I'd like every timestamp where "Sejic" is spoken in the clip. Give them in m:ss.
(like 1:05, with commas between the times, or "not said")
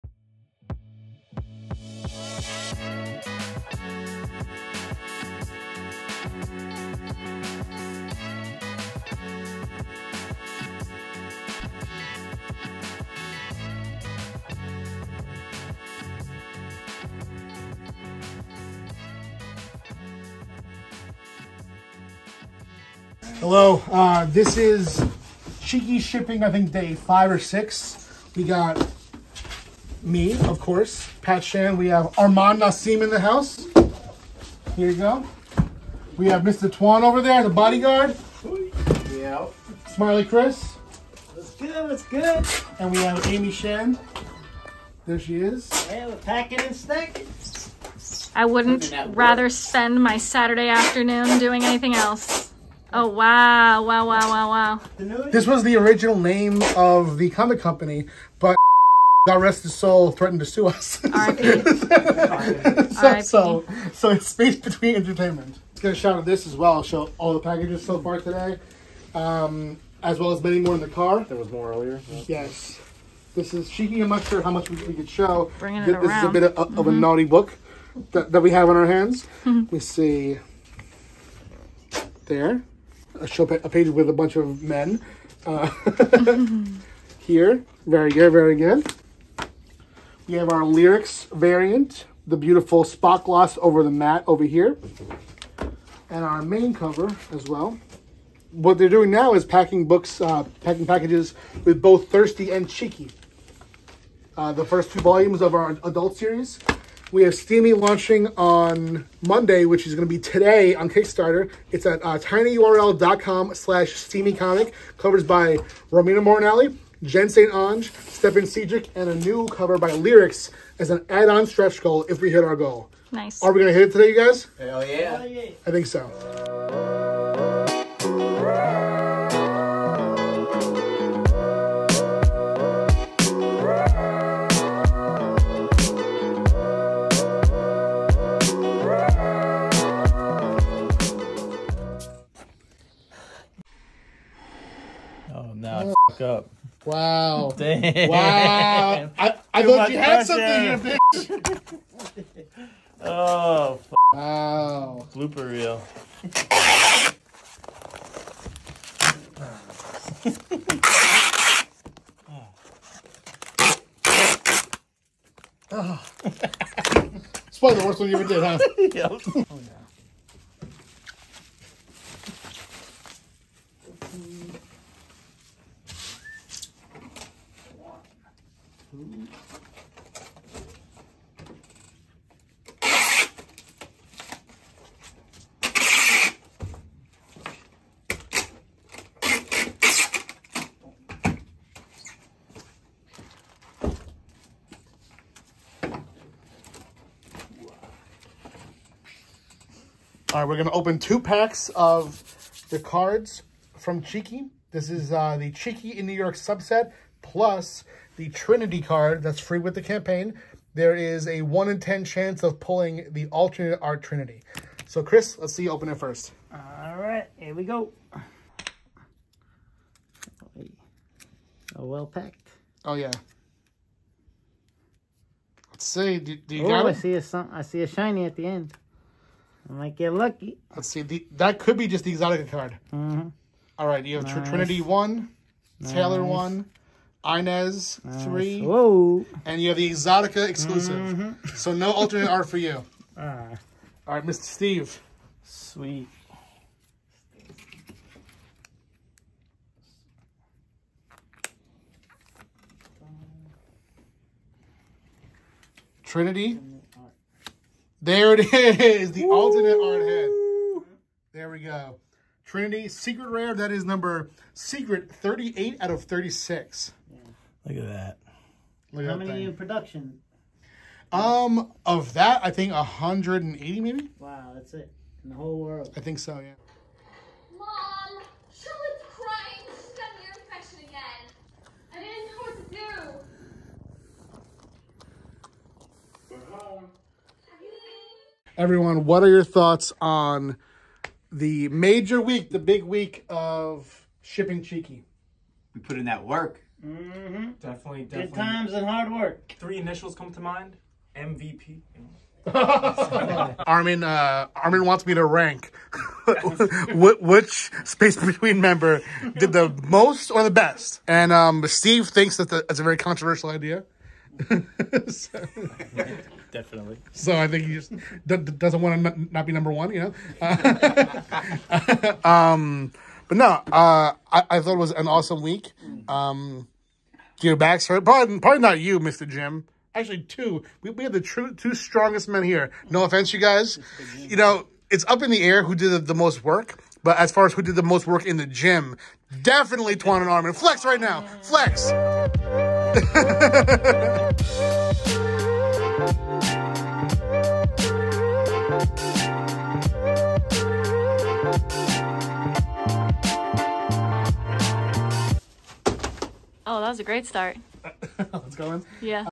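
1:58.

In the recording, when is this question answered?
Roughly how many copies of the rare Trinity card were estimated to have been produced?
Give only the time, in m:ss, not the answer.
4:32.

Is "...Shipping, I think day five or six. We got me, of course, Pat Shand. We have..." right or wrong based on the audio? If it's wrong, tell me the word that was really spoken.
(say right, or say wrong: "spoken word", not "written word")
right.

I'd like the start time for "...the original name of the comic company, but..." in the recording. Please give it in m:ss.
0:55.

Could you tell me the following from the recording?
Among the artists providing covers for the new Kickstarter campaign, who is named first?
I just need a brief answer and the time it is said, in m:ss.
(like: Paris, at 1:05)
Romina Moranelli, at 1:55.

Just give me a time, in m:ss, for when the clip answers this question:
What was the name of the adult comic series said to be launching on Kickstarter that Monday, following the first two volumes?
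1:47.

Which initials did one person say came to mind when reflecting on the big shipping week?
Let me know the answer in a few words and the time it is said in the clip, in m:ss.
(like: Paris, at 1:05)
MVP, at 5:01.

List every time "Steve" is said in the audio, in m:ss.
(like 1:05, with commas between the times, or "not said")
4:04, 5:11.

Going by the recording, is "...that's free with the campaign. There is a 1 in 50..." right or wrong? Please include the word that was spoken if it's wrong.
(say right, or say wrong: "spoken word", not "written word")
wrong: "10", not "50".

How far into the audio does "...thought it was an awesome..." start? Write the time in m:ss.
5:24.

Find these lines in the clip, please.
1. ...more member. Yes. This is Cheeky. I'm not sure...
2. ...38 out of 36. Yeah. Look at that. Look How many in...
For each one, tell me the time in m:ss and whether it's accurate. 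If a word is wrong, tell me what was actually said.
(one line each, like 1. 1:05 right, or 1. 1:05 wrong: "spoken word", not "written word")
1. 1:11 wrong: "earlier", not "member"
2. 4:25 right.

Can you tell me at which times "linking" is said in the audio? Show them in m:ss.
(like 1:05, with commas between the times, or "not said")
not said.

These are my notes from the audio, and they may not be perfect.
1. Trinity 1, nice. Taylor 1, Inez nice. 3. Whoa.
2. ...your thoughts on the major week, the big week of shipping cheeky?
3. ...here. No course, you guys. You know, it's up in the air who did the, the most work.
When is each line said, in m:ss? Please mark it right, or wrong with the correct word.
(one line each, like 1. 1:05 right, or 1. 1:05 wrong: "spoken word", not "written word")
1. 3:54 right
2. 4:49 right
3. 5:32 wrong: "offense", not "course".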